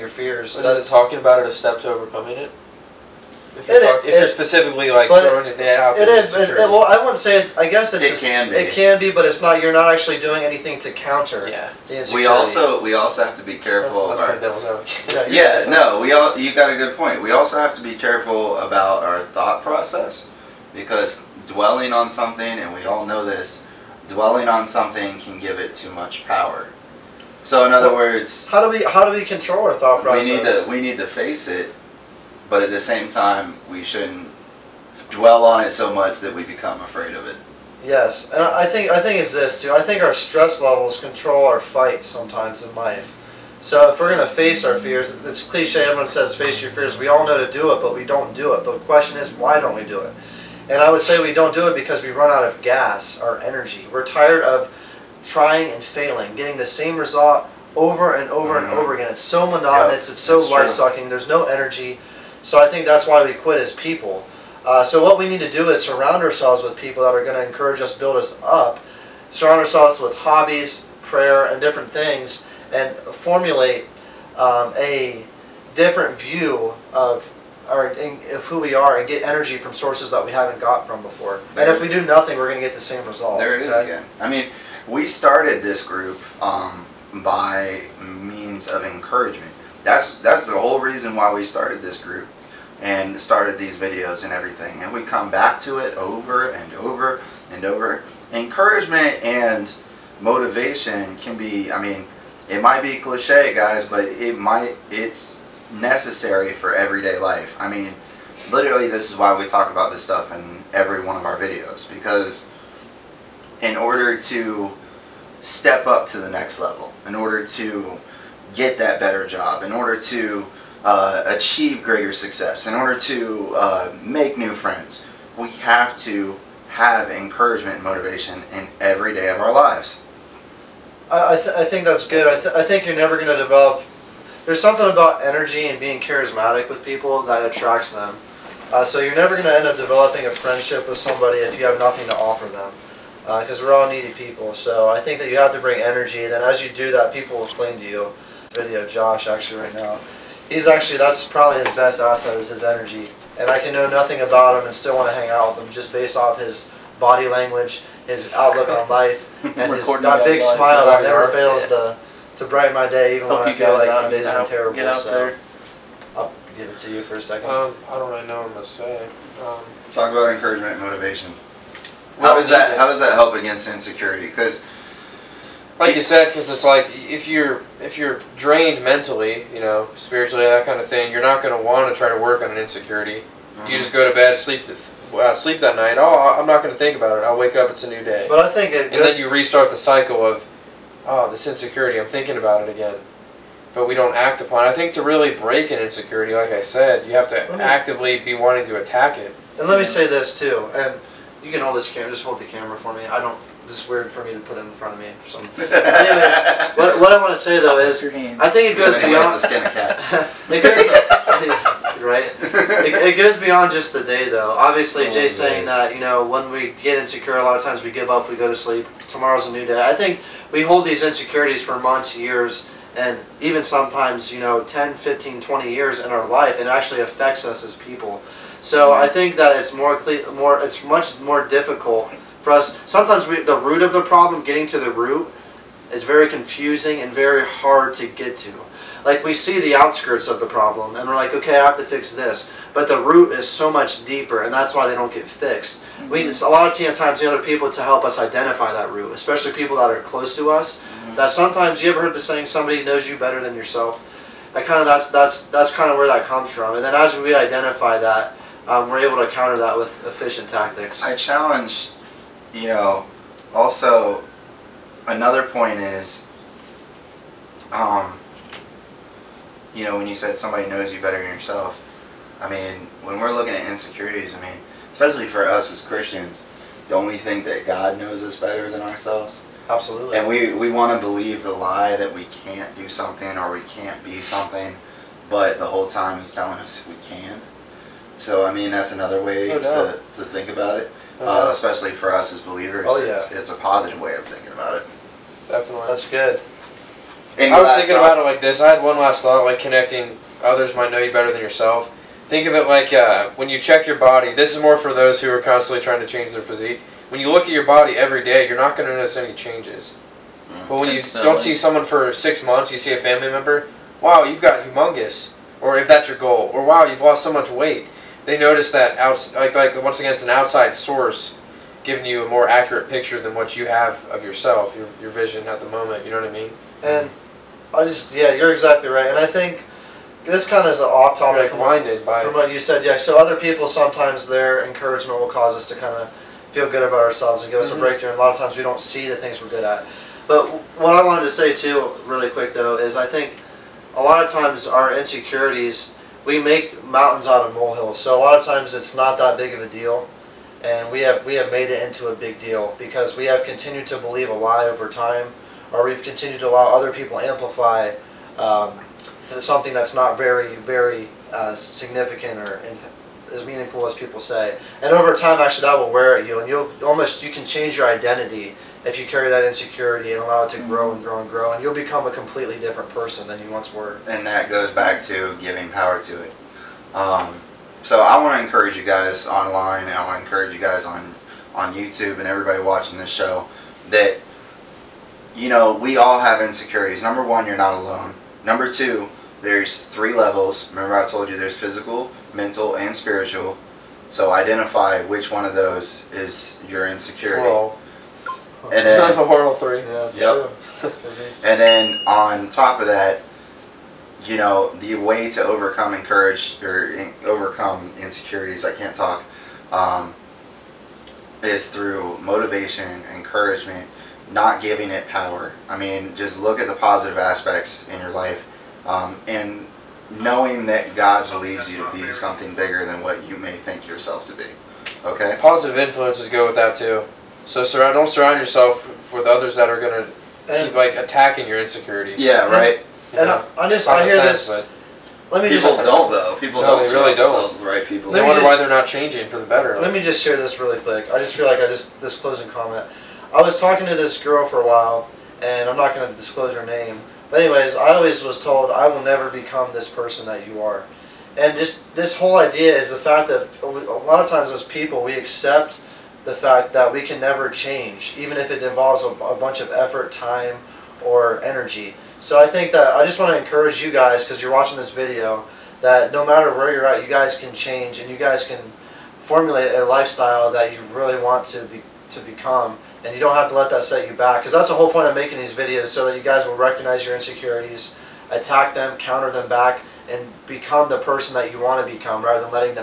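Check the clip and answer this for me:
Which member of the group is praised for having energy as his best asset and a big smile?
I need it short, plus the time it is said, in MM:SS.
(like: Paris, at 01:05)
Josh, at 02:28.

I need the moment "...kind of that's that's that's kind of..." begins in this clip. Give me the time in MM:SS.
04:14.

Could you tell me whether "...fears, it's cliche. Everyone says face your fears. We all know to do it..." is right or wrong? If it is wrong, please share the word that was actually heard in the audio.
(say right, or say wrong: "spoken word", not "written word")
right.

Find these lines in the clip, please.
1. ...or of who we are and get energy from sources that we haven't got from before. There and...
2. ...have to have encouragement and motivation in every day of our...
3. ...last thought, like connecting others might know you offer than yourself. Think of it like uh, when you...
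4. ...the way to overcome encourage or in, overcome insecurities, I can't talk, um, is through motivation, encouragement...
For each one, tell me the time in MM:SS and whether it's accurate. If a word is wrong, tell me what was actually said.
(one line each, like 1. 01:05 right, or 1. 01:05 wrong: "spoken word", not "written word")
1. 01:17 right
2. 02:05 right
3. 04:58 wrong: "better", not "offer"
4. 06:44 right.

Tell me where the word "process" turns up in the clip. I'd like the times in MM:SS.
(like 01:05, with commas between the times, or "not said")
00:19, 00:30.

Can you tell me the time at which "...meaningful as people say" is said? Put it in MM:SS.
06:03.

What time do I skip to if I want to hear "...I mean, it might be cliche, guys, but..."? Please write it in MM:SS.
01:41.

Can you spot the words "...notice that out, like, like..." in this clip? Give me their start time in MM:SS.
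05:18.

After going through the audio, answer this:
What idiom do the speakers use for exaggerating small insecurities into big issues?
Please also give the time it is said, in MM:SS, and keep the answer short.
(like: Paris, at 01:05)
Mountains out of molehills, at 05:46.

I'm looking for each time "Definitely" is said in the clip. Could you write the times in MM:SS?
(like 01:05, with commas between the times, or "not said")
04:55.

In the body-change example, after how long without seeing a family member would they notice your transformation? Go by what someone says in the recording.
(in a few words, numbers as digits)
Six months.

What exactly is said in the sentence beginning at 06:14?
And that goes back to giving power to it.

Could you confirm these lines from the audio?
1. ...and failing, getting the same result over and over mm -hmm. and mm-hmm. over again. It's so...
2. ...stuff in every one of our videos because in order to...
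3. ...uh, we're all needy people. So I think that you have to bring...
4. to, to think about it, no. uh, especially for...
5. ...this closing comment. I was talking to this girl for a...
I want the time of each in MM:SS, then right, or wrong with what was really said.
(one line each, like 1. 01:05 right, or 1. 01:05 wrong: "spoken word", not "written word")
1. 00:55 right
2. 01:50 right
3. 02:23 right
4. 04:49 right
5. 07:22 right.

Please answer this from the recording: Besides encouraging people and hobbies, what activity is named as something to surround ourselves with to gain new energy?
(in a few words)
Prayer.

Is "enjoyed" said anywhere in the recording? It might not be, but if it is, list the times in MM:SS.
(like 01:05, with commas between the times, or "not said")
not said.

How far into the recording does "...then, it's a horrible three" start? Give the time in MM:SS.
06:38.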